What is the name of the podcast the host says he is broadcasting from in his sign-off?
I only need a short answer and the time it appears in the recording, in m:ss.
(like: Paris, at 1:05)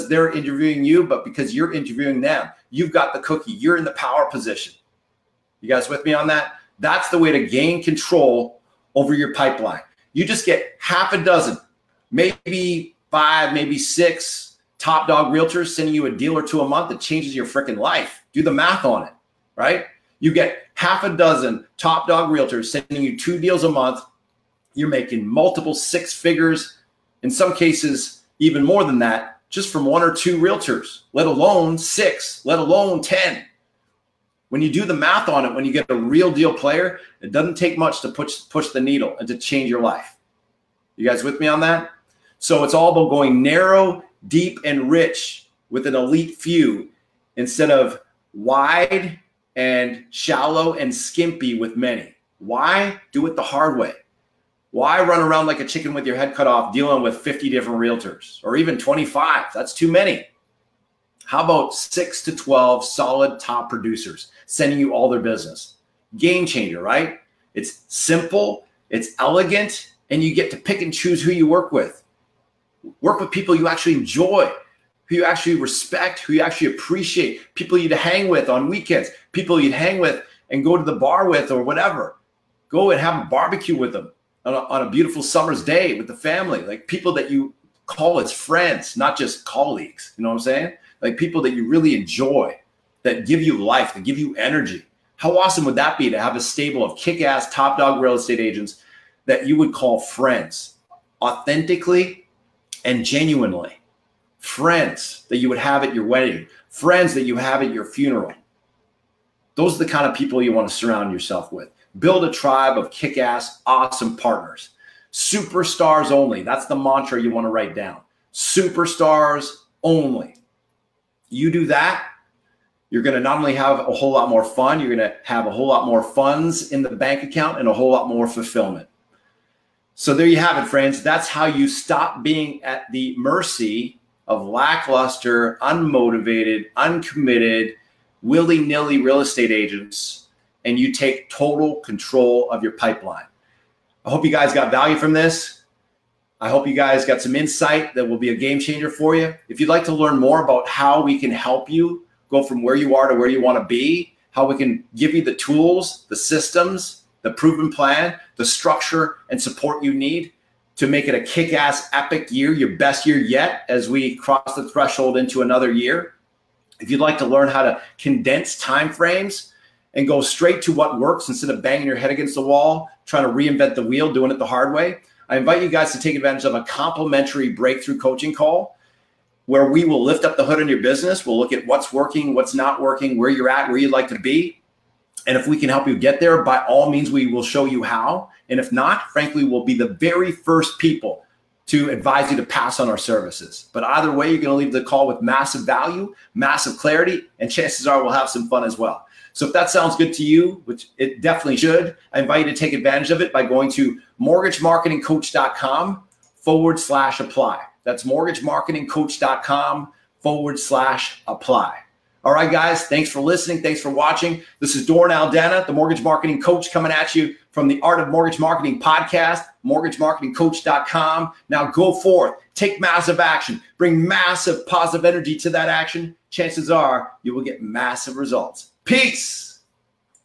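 Art of Mortgage Marketing, at 3:37.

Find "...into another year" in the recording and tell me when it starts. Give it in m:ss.
2:45.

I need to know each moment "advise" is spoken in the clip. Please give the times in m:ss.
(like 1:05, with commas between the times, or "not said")
3:11.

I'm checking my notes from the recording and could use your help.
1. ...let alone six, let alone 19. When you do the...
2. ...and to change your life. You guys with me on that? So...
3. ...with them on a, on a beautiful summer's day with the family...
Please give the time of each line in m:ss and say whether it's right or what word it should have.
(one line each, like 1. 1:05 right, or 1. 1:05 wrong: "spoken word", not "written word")
1. 0:31 wrong: "10", not "19"
2. 0:39 right
3. 1:23 right.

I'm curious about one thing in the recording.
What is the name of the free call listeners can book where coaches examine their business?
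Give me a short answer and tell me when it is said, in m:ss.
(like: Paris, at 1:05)
Breakthrough coaching call, at 2:57.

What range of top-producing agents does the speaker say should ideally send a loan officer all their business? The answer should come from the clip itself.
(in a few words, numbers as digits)
6 to 12.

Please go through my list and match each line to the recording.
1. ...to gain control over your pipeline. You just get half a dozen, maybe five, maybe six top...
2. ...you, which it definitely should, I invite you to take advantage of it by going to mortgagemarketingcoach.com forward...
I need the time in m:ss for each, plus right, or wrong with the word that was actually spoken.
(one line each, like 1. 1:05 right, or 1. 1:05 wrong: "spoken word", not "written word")
1. 0:07 right
2. 3:20 right.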